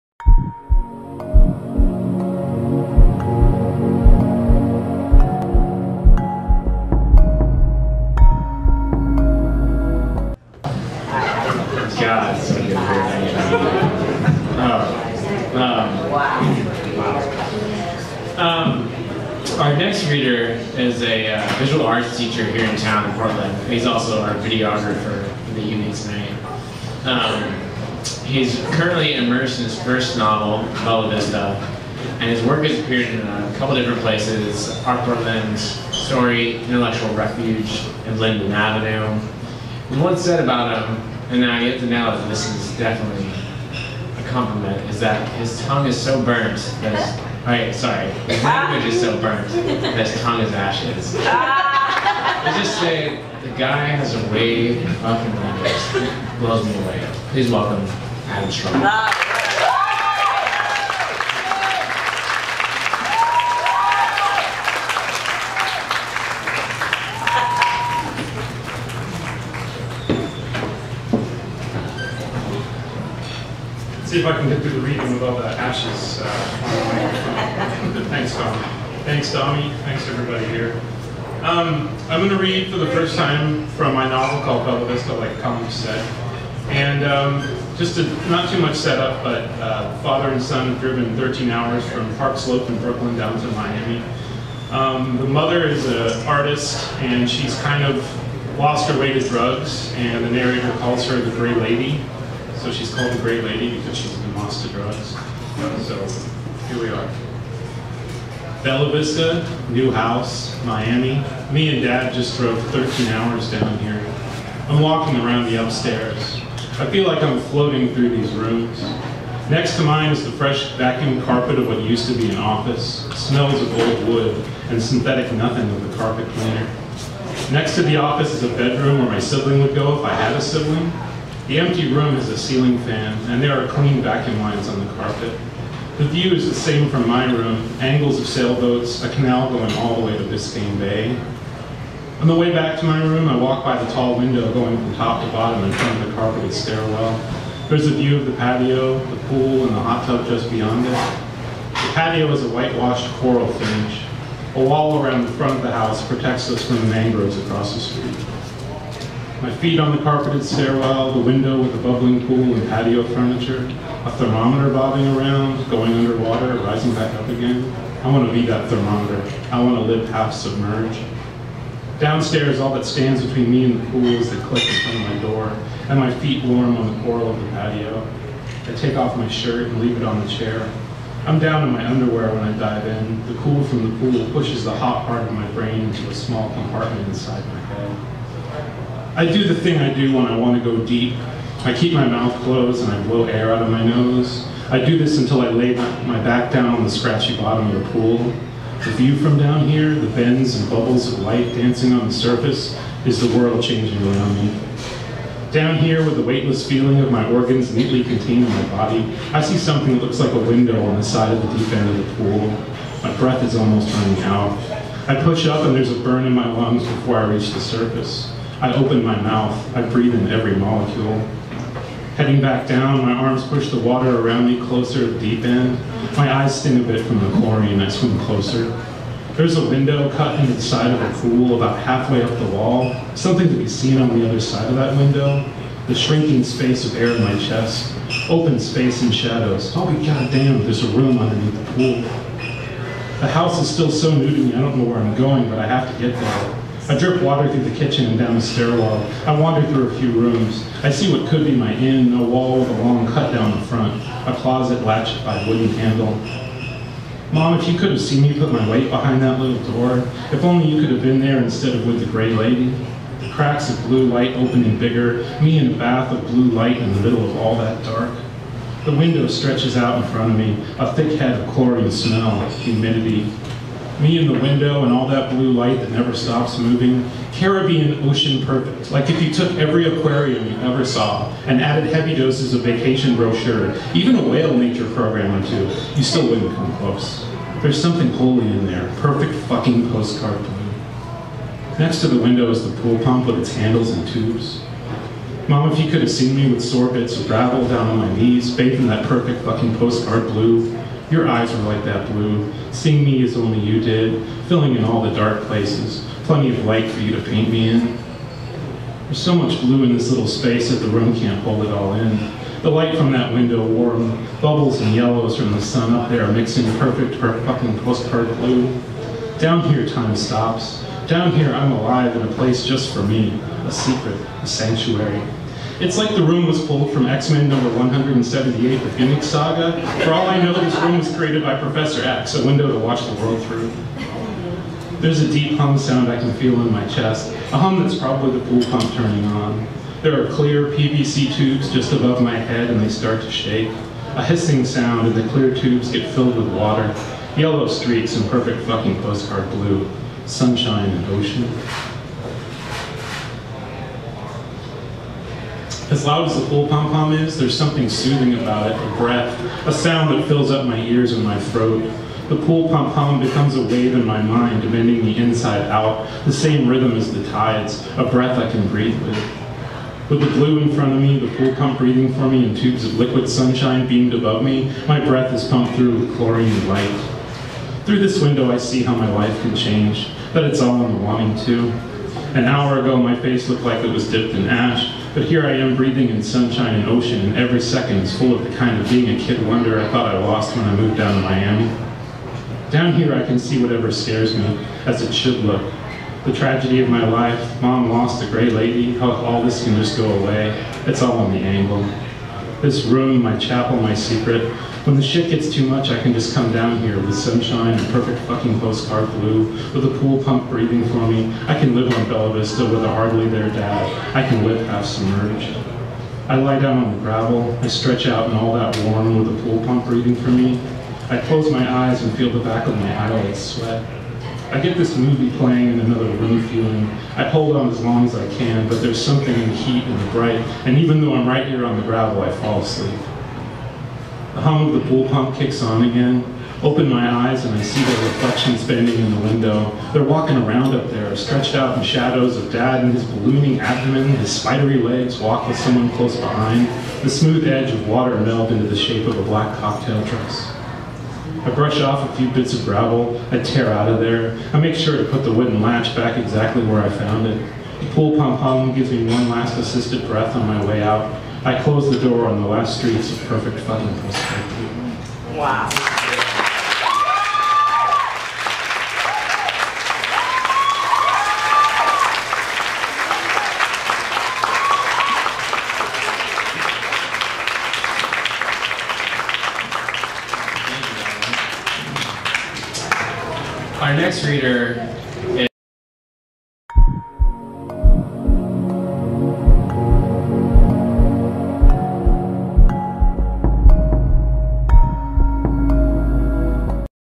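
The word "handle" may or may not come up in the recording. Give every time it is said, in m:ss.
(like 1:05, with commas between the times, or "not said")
4:15, 4:53.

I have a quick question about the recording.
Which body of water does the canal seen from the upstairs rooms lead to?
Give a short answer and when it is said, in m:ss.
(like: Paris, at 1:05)
Biscayne Bay, at 2:20.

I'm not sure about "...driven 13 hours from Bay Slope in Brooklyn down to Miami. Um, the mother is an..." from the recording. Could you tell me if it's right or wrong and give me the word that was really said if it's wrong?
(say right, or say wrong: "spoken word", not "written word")
wrong: "Park", not "Bay".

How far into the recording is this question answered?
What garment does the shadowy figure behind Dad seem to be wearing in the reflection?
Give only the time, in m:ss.
7:29.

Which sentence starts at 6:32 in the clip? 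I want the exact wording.
Down here I can see whatever scares me, as it should look.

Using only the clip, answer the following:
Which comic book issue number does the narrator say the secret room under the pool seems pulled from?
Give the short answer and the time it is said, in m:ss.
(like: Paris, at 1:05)
178, at 5:27.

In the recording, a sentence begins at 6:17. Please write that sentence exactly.
Through this window, I see how my life can change, but it's all in the wanting, too.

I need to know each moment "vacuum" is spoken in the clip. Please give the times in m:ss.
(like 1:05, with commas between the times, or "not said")
2:00, 2:14.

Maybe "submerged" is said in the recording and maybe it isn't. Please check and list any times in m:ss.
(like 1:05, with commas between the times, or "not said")
2:50, 6:54.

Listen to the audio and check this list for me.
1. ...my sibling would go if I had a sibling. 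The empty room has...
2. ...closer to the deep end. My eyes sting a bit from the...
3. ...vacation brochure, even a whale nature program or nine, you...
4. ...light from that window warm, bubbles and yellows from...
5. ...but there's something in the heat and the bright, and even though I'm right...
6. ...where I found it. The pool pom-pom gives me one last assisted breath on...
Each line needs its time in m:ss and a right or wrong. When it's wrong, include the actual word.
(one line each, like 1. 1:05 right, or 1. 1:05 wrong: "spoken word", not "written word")
1. 2:09 right
2. 3:44 right
3. 4:42 wrong: "two", not "nine"
4. 5:12 right
5. 7:08 right
6. 7:36 right.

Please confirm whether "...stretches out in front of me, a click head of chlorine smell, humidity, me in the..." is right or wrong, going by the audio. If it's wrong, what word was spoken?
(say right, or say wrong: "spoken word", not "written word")
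wrong: "thick", not "click".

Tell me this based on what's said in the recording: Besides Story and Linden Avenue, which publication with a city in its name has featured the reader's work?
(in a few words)
Art Portland.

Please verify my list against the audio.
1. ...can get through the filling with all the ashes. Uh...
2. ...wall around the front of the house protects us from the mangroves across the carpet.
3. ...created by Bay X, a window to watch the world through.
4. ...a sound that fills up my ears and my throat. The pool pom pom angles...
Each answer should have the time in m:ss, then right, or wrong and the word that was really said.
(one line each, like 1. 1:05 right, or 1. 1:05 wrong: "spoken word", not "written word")
1. 1:14 wrong: "reading", not "filling"
2. 2:34 wrong: "street", not "carpet"
3. 5:31 wrong: "Professor", not "Bay"
4. 5:59 wrong: "becomes", not "angles".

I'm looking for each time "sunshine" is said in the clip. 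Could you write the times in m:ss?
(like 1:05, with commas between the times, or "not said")
5:50, 6:13, 6:26, 6:47.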